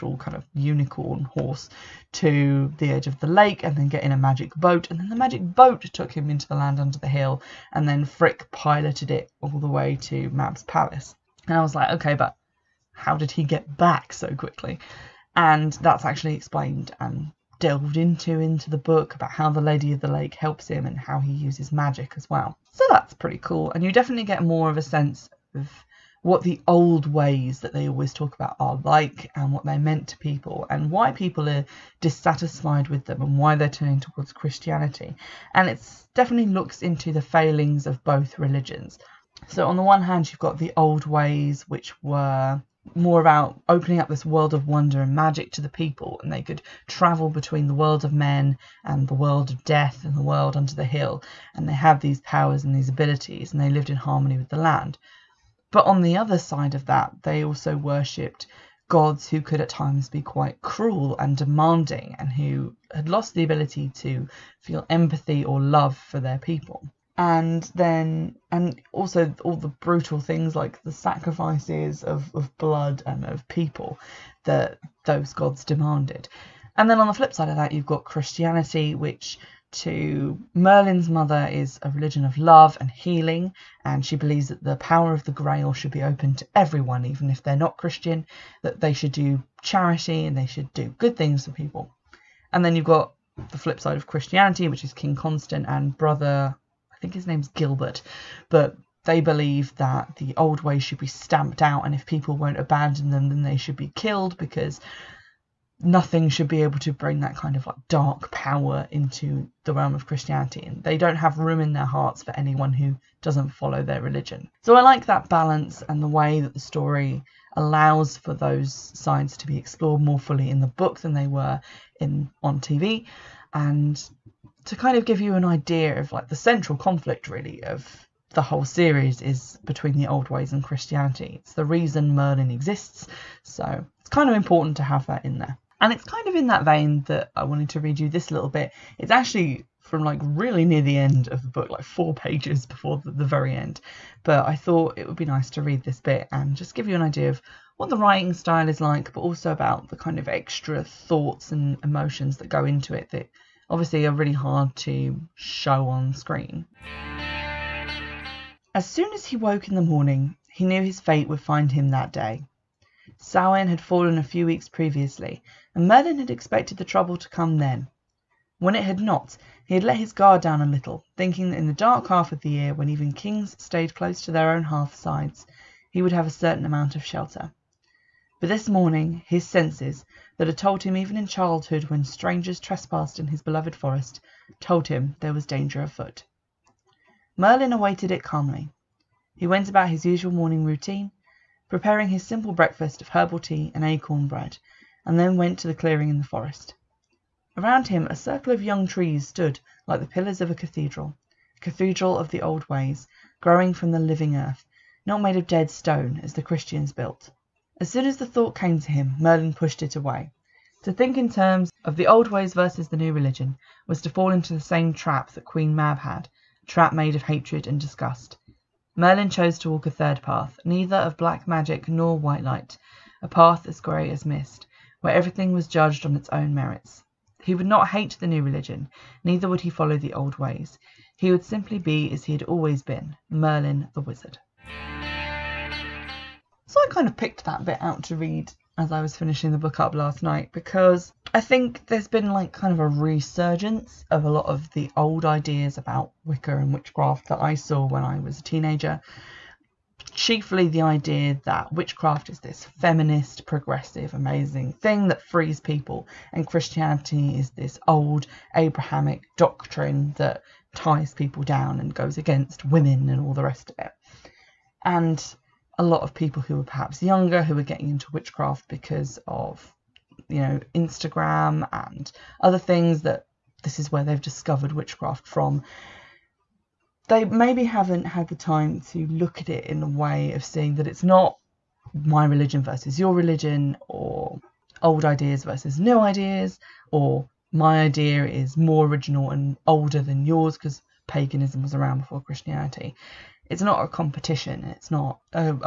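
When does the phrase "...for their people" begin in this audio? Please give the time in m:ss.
1:05.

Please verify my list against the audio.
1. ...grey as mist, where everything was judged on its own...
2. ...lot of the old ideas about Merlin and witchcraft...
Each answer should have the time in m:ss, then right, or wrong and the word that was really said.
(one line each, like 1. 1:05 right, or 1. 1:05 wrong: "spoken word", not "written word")
1. 3:43 right
2. 4:04 wrong: "Wicca", not "Merlin".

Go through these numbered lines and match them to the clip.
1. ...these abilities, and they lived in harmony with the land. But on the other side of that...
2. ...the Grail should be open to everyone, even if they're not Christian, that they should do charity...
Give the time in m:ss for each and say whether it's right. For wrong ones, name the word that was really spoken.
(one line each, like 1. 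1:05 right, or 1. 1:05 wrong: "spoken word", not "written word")
1. 0:52 right
2. 1:25 right.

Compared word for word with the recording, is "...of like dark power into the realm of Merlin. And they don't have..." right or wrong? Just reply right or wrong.
wrong.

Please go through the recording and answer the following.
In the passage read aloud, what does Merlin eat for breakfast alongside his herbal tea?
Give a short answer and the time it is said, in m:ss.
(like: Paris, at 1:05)
Acorn bread, at 3:13.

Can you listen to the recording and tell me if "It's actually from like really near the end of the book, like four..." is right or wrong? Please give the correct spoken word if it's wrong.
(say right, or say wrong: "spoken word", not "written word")
right.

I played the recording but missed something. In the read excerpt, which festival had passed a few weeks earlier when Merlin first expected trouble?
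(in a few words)
Samhain.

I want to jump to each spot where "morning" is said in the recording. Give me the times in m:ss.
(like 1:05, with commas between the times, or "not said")
2:39, 2:58, 3:10.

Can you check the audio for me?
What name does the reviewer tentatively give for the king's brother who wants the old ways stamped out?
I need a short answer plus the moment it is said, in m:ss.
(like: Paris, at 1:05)
Gilbert, at 1:37.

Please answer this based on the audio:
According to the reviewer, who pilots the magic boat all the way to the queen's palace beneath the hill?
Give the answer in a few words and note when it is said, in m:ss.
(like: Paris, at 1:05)
Frik, at 0:08.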